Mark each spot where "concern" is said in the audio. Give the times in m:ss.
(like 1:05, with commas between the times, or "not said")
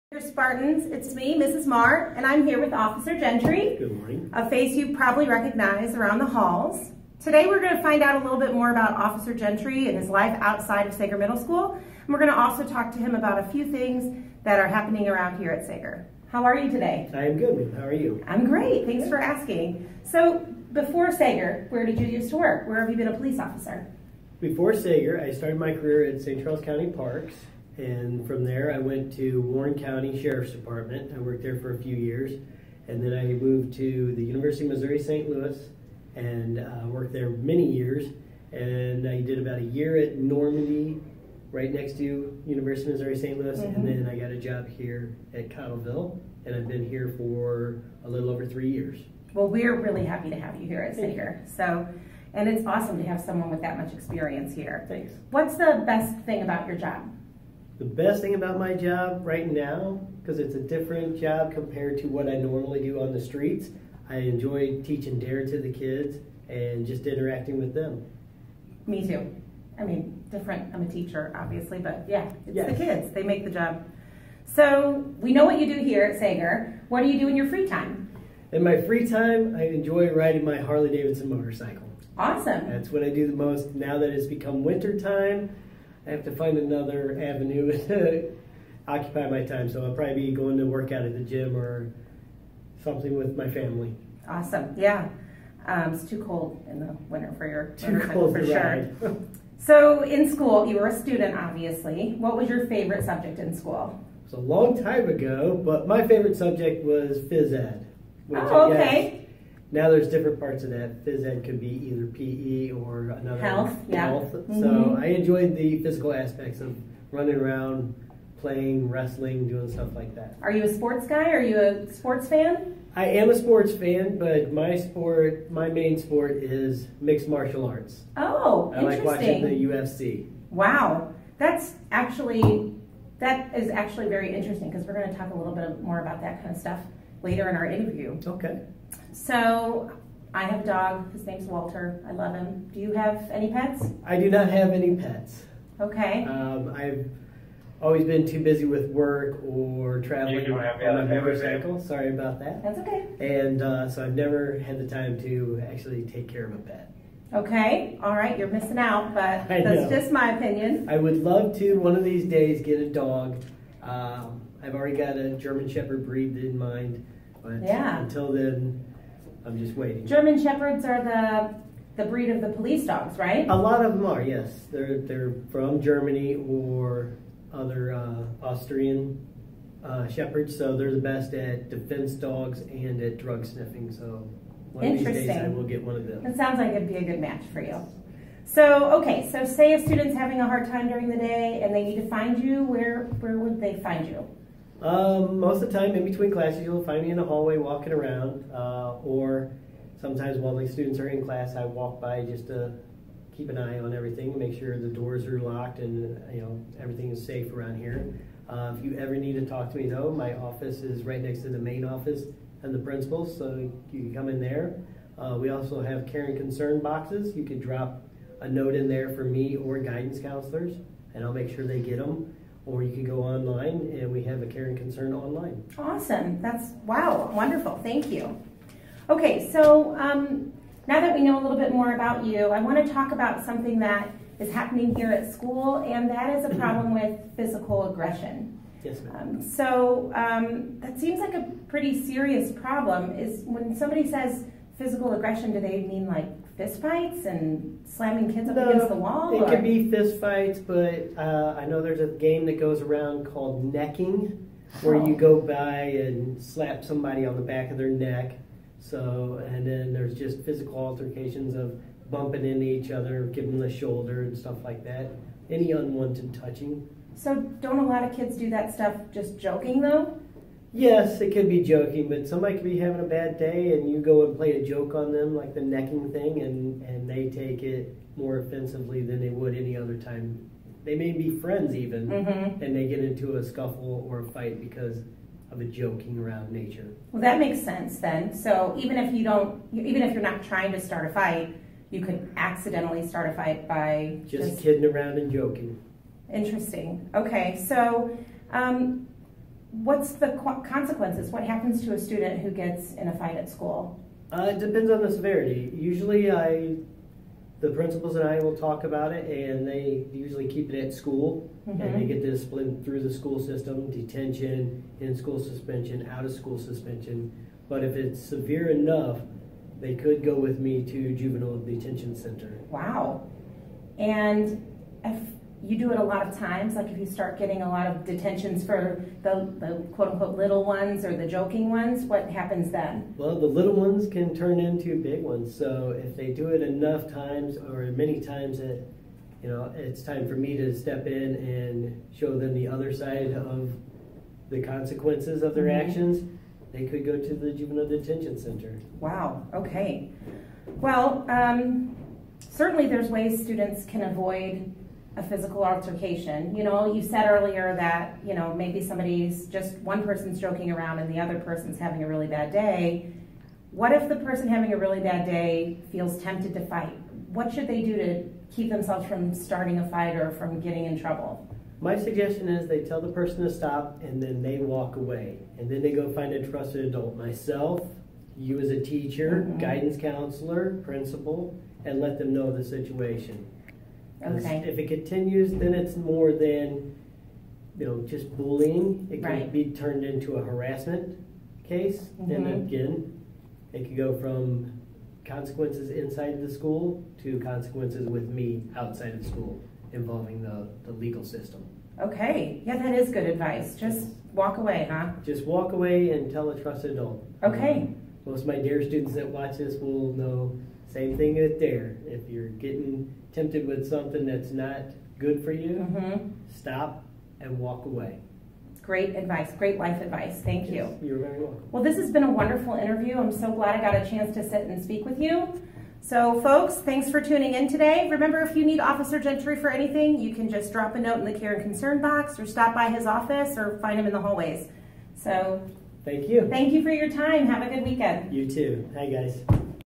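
3:36, 3:44, 7:11.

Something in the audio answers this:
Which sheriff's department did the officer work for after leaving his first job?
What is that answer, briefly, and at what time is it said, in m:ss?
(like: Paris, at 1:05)
Warren County, at 0:29.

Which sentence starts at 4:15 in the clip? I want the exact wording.
by and slap somebody on the back of their neck.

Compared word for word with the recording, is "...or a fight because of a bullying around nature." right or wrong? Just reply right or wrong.
wrong.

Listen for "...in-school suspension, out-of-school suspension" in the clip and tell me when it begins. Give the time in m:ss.
5:14.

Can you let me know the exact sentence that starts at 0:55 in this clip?
What's the best thing about your job?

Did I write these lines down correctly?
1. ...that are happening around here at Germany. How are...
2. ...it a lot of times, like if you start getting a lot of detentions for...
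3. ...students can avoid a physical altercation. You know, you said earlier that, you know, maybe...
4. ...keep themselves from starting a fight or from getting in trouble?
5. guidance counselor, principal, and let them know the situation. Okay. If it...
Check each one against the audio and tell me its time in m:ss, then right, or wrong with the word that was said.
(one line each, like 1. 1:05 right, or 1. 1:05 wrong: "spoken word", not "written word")
1. 0:14 wrong: "Saeger", not "Germany"
2. 5:25 right
3. 5:53 right
4. 6:08 right
5. 6:19 right.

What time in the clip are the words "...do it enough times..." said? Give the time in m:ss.
5:36.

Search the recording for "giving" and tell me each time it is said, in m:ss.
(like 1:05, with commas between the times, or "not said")
4:23.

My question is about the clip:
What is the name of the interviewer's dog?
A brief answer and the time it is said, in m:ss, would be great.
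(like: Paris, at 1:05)
Walter, at 2:21.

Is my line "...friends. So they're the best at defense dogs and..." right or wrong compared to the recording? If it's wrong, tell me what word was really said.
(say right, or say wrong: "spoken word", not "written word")
wrong: "shepherds", not "friends".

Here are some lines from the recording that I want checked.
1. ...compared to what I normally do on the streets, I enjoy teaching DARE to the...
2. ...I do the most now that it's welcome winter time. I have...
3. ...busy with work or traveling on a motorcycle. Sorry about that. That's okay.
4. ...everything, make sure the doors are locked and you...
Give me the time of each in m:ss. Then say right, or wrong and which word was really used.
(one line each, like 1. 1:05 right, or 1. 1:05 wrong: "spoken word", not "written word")
1. 1:01 right
2. 1:23 wrong: "become", not "welcome"
3. 2:28 right
4. 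3:23 right.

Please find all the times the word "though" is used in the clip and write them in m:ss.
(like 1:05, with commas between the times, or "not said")
3:29, 4:29.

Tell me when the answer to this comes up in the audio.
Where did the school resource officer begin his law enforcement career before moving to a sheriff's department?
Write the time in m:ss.
0:26.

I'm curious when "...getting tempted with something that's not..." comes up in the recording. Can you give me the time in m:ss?
6:52.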